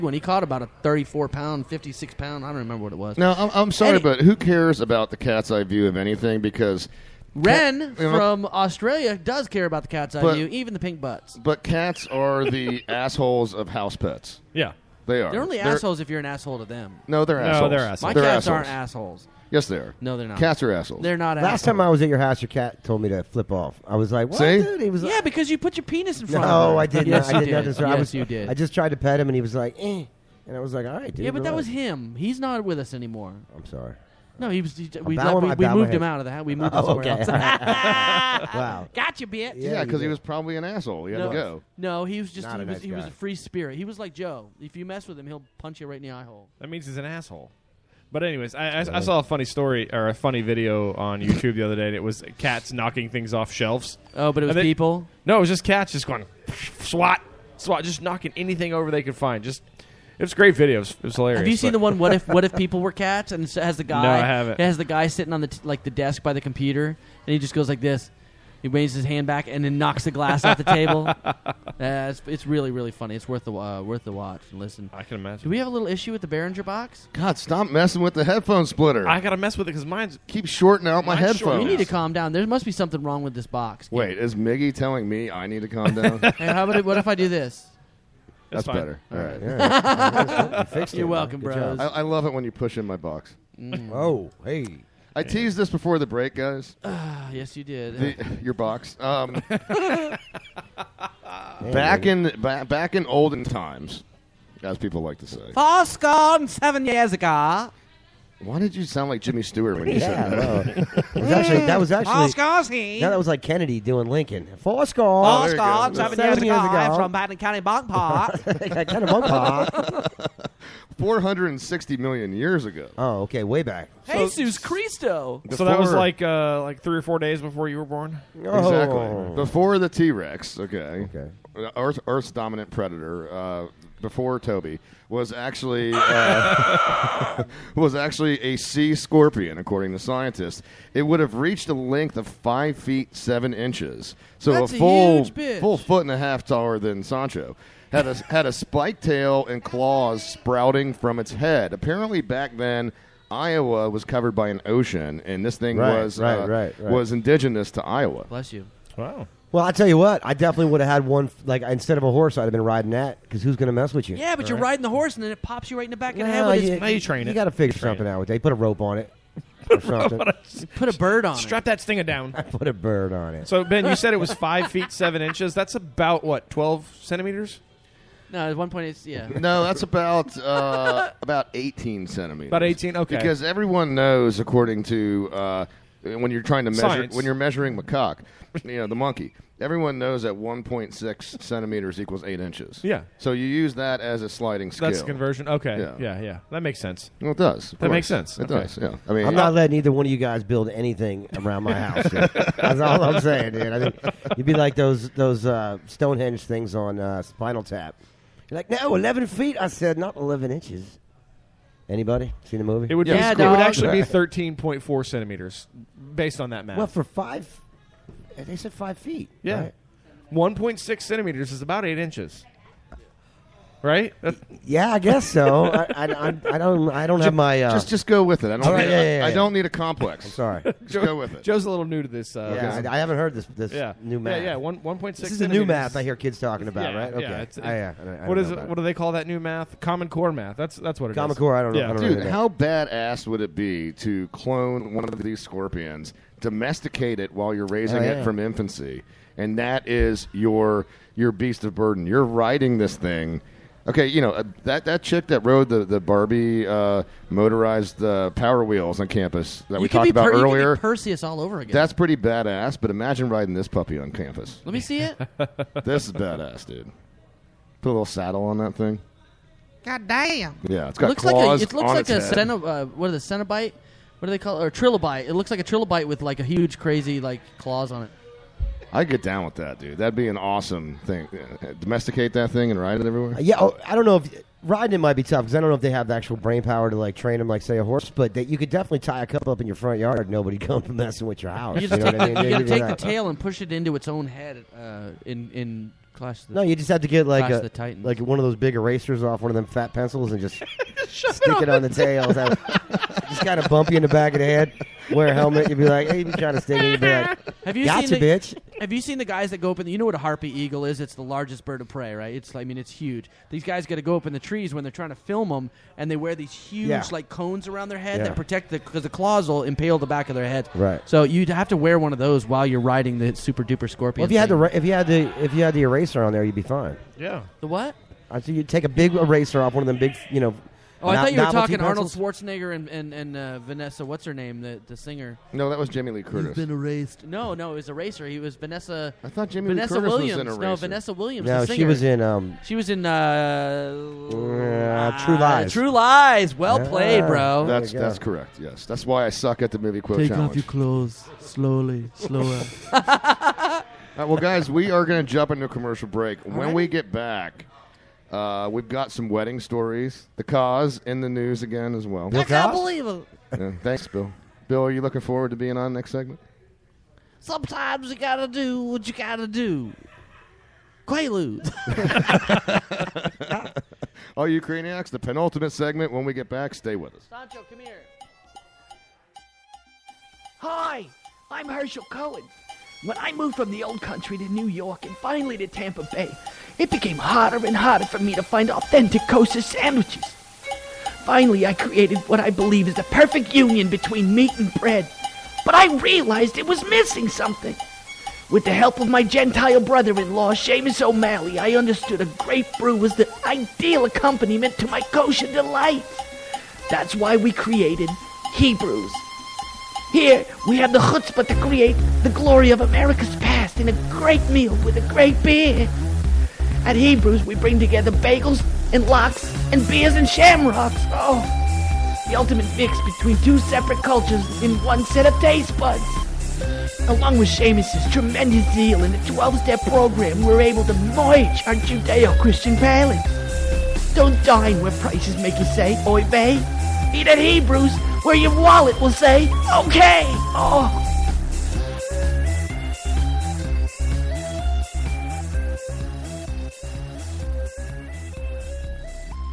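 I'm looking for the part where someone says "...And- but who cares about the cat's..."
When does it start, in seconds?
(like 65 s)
3 s.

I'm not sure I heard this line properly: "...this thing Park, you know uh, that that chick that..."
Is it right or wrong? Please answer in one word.
wrong.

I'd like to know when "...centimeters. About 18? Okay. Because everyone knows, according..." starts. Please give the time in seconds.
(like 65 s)
182 s.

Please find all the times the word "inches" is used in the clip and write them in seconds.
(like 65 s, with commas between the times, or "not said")
143 s, 175 s, 192 s, 210 s, 221 s.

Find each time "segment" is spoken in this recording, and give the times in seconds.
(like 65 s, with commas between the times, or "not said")
366 s, 375 s.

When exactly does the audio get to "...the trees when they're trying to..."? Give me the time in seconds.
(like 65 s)
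314 s.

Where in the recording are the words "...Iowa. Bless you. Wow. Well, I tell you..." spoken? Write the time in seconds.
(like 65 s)
157 s.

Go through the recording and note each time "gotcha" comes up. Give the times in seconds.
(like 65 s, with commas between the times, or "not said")
38 s, 307 s.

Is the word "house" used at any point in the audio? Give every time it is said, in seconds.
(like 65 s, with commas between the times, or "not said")
13 s, 22 s, 36 s, 201 s, 291 s.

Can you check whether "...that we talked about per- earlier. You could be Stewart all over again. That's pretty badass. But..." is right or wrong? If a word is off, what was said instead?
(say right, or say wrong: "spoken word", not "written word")
wrong: "Perseus", not "Stewart".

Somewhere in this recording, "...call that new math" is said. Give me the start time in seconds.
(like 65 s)
238 s.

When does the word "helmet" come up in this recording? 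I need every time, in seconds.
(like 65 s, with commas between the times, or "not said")
305 s.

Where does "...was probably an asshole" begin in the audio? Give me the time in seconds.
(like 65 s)
40 s.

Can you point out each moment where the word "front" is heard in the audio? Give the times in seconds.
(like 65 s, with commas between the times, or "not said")
26 s, 289 s.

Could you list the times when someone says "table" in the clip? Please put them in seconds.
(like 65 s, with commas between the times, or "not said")
70 s.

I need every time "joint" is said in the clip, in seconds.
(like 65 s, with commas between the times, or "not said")
not said.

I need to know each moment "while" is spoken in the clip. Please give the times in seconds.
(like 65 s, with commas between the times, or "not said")
247 s, 322 s.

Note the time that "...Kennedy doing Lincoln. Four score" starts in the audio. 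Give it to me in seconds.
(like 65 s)
113 s.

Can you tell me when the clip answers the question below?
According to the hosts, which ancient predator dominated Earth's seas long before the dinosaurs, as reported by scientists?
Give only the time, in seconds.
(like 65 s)
138 s.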